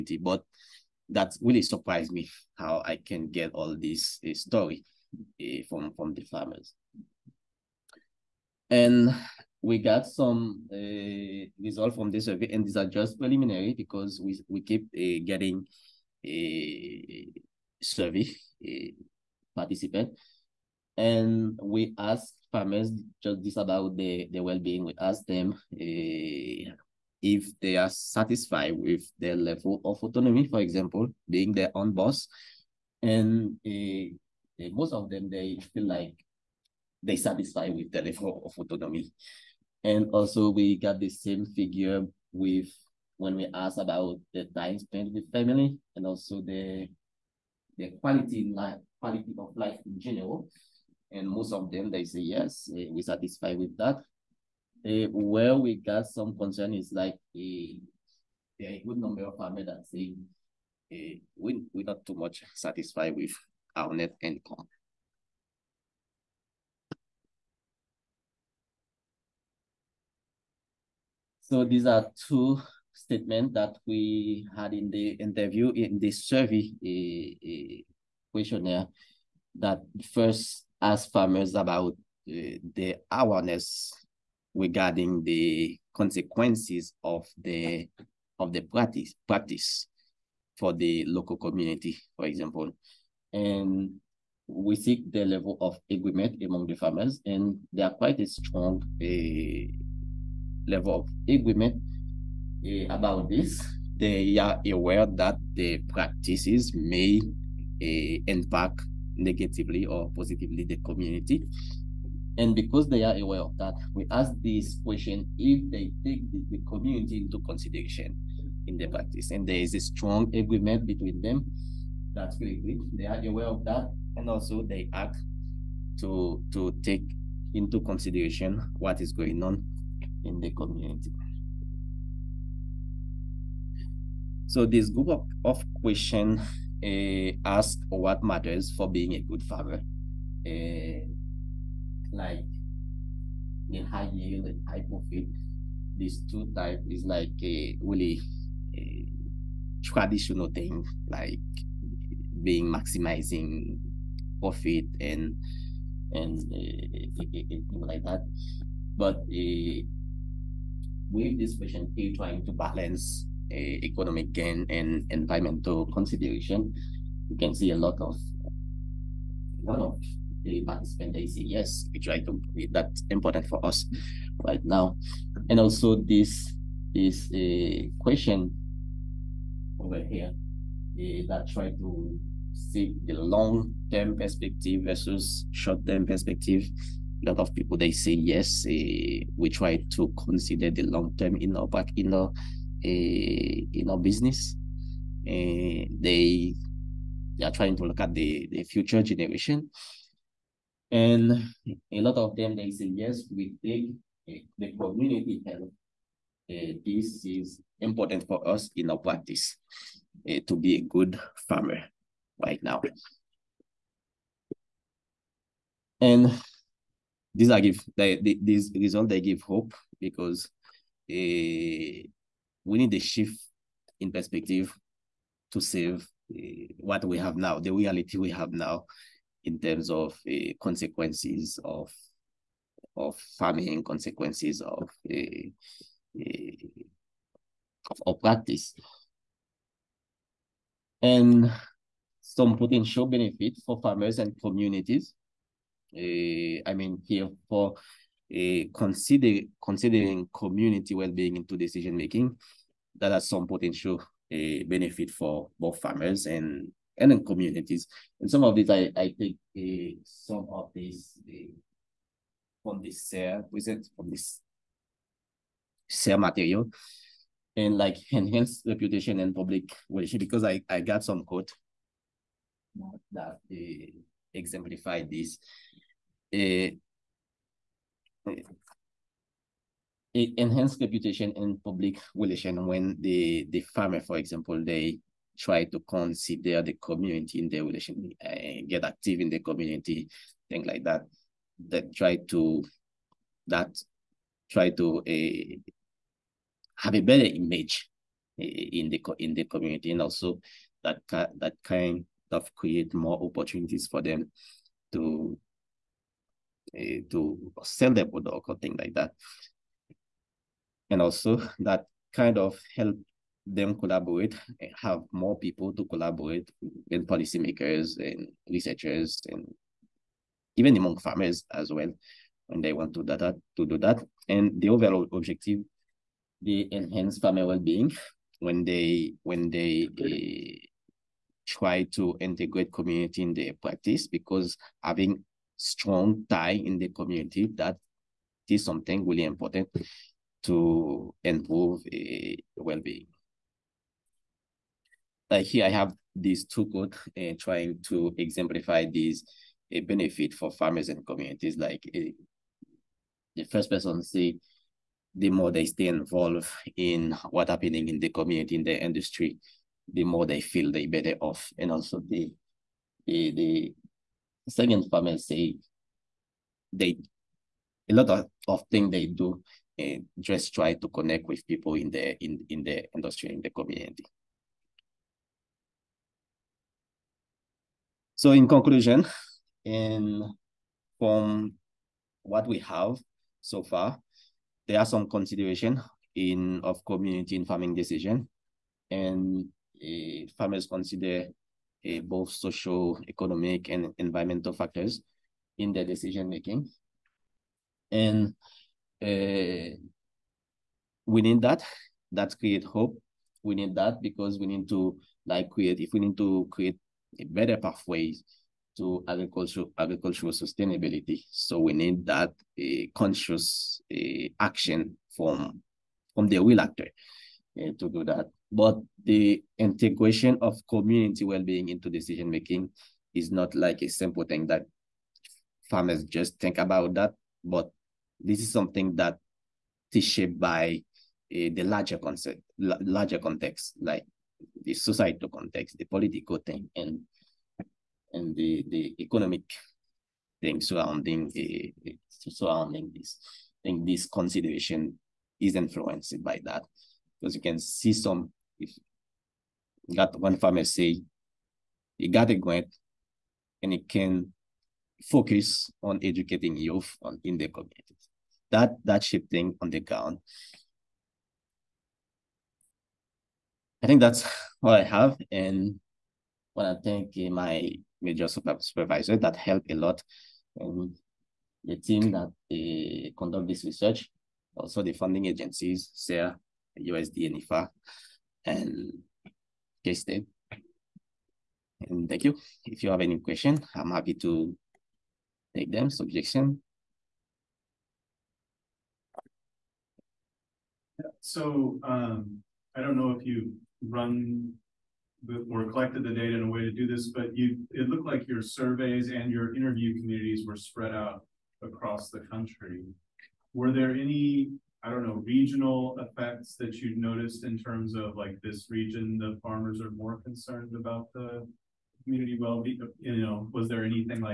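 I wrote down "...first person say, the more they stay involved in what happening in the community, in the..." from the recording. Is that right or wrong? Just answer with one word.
right.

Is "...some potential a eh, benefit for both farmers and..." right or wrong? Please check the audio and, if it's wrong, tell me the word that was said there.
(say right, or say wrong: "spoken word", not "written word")
right.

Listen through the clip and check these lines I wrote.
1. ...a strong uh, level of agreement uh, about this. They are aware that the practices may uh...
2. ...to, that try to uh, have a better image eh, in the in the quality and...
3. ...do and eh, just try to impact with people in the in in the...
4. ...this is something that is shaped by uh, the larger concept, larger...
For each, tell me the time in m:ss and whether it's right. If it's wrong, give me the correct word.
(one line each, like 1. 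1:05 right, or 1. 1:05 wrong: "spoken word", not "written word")
1. 1:38 right
2. 4:52 wrong: "community", not "quality"
3. 6:09 wrong: "connect", not "impact"
4. 7:08 right.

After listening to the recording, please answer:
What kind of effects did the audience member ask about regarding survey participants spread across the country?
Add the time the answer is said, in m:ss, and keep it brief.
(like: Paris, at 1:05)
Regional effects, at 8:25.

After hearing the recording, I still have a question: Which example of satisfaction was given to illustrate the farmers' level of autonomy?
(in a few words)
Being their own boss.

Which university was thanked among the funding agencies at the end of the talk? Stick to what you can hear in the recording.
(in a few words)
K-State.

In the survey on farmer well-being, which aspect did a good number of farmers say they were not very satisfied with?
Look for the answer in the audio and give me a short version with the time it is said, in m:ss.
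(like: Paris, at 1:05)
Net income, at 1:03.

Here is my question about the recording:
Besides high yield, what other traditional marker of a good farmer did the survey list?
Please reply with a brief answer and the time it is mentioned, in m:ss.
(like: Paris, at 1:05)
High profit, at 2:24.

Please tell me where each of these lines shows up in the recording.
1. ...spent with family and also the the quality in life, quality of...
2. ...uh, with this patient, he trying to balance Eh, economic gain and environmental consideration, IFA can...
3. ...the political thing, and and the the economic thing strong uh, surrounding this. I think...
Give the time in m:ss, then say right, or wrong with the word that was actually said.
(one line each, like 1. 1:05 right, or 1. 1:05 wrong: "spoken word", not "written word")
1. 0:44 right
2. 2:39 wrong: "You", not "IFA"
3. 7:15 wrong: "surrounding", not "strong".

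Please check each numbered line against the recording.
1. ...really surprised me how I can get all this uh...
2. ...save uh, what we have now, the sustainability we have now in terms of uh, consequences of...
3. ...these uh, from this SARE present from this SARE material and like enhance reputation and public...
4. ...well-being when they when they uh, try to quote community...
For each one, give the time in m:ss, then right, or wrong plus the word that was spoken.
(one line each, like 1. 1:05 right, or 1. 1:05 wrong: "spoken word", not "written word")
1. 0:01 right
2. 3:45 wrong: "reality", not "sustainability"
3. 4:20 right
4. 5:27 wrong: "integrate", not "quote".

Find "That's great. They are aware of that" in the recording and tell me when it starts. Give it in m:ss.
2:02.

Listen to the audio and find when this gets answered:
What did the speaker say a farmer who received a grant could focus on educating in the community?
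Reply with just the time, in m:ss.
7:36.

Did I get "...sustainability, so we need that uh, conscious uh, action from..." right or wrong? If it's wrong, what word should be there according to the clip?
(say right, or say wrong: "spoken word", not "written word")
right.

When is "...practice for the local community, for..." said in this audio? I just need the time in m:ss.
1:29.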